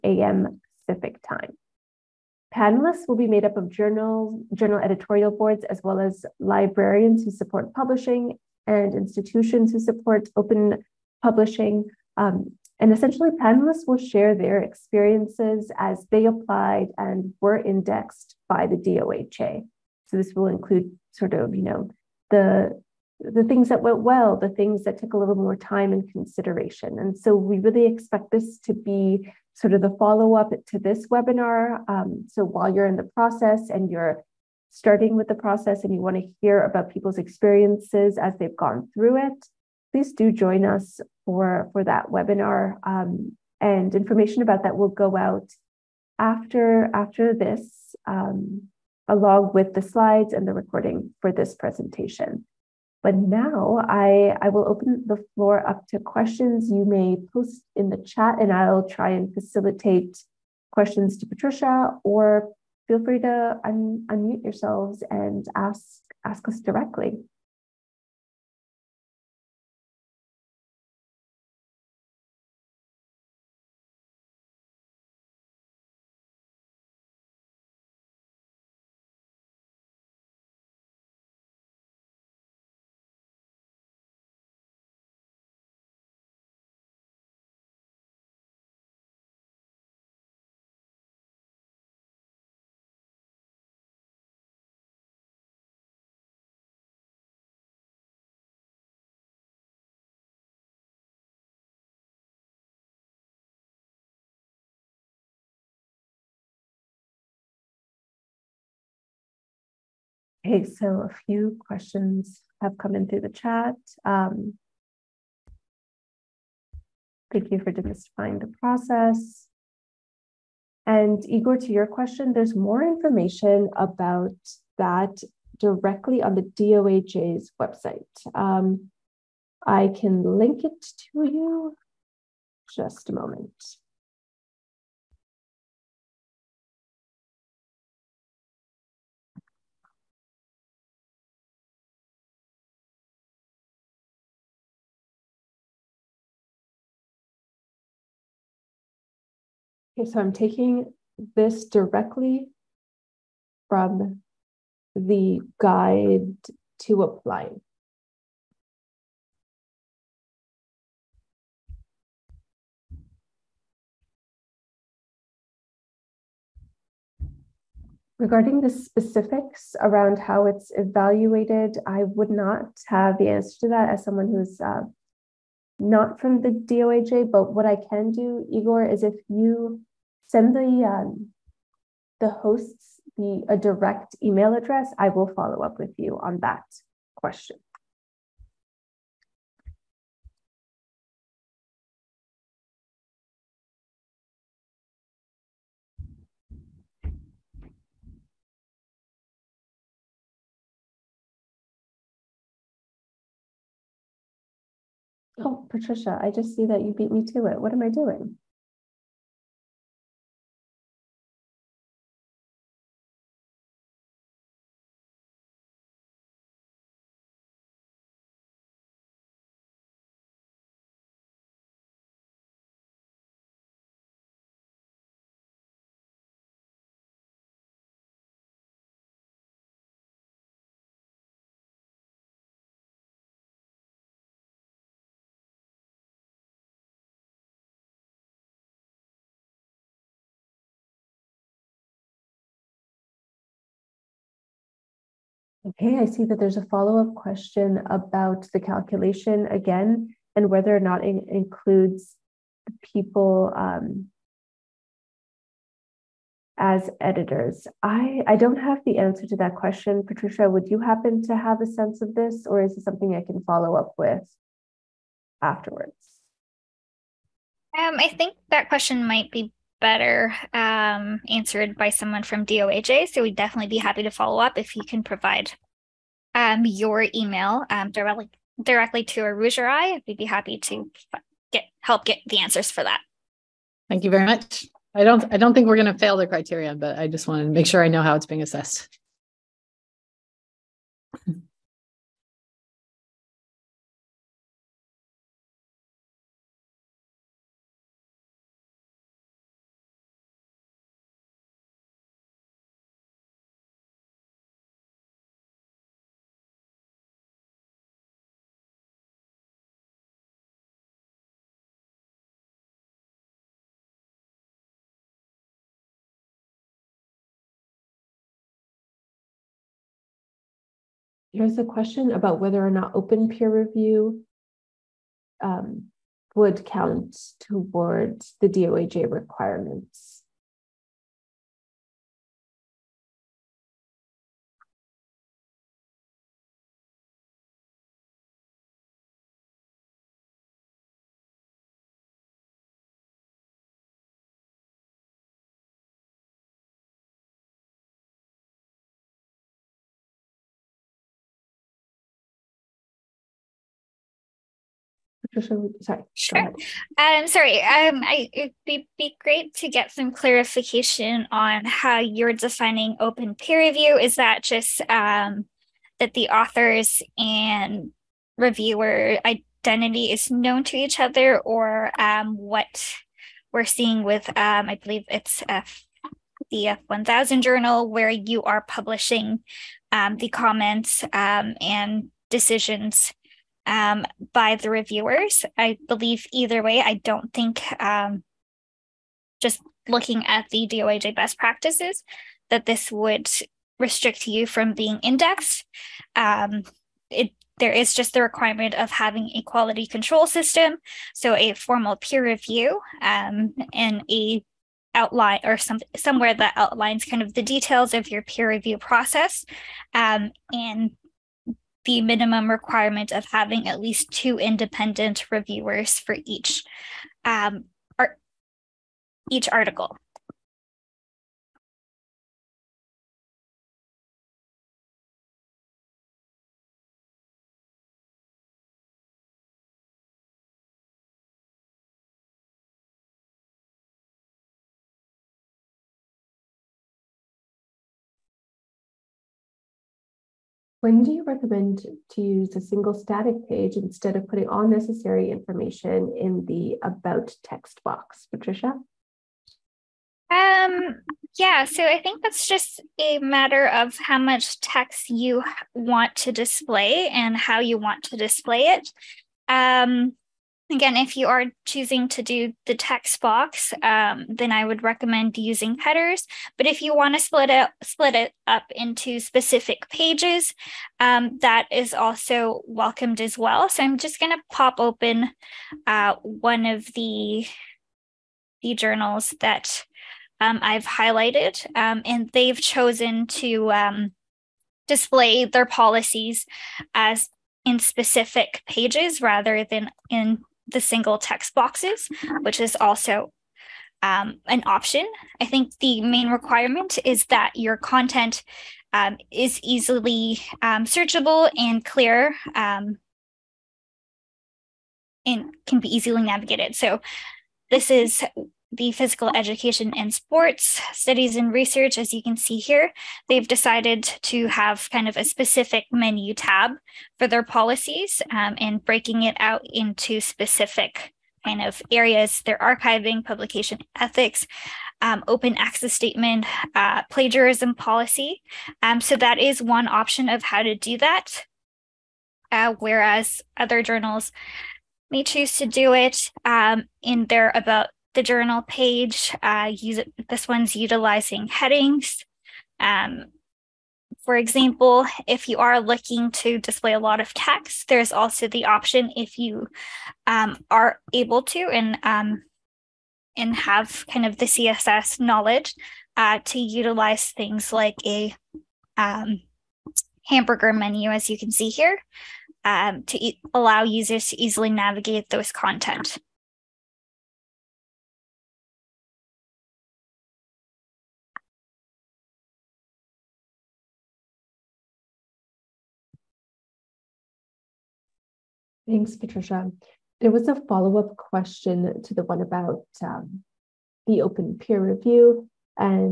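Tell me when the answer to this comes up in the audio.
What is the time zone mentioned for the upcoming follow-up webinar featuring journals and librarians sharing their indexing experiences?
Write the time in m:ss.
0:00.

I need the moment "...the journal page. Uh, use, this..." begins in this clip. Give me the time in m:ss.
8:58.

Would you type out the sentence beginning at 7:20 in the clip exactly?
When do you recommend to use a single static page instead of putting all necessary information in the about text box, Patricia?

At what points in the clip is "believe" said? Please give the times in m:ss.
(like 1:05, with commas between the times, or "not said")
6:14, 6:25.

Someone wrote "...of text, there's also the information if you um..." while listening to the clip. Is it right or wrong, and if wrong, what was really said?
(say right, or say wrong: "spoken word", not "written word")
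wrong: "option", not "information".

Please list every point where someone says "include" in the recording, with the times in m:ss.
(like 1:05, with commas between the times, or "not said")
0:20, 4:11.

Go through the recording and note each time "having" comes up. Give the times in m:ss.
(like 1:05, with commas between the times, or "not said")
6:38, 6:53.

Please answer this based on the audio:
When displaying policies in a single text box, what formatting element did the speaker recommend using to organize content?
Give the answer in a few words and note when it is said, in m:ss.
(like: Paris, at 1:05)
Headers, at 7:45.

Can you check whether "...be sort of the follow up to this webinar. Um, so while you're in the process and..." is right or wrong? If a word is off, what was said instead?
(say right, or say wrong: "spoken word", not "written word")
right.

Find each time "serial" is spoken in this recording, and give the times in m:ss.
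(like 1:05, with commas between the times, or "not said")
not said.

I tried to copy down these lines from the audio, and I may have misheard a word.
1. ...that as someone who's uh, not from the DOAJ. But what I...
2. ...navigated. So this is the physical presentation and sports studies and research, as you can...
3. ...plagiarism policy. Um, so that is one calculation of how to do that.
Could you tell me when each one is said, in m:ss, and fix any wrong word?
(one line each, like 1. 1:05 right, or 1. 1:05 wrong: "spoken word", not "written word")
1. 2:53 right
2. 8:26 wrong: "education", not "presentation"
3. 8:47 wrong: "option", not "calculation".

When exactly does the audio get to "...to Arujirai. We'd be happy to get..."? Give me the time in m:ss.
4:39.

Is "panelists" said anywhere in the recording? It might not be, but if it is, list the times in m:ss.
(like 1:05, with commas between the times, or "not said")
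0:02, 0:13.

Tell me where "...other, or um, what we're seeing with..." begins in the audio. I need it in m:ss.
6:10.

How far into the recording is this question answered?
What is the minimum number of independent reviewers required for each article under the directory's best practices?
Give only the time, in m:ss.
6:54.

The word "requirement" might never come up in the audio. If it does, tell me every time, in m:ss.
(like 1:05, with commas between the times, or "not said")
5:29, 6:38, 6:52, 8:16.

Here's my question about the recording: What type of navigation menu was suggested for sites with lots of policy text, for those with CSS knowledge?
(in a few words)
Hamburger menu.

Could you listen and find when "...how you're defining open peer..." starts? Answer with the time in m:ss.
6:01.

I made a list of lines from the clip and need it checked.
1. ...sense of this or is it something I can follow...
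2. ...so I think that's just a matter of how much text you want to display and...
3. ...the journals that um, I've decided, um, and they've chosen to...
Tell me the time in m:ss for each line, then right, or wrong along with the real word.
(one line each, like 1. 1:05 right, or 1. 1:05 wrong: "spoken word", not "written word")
1. 4:21 right
2. 7:31 right
3. 7:58 wrong: "highlighted", not "decided".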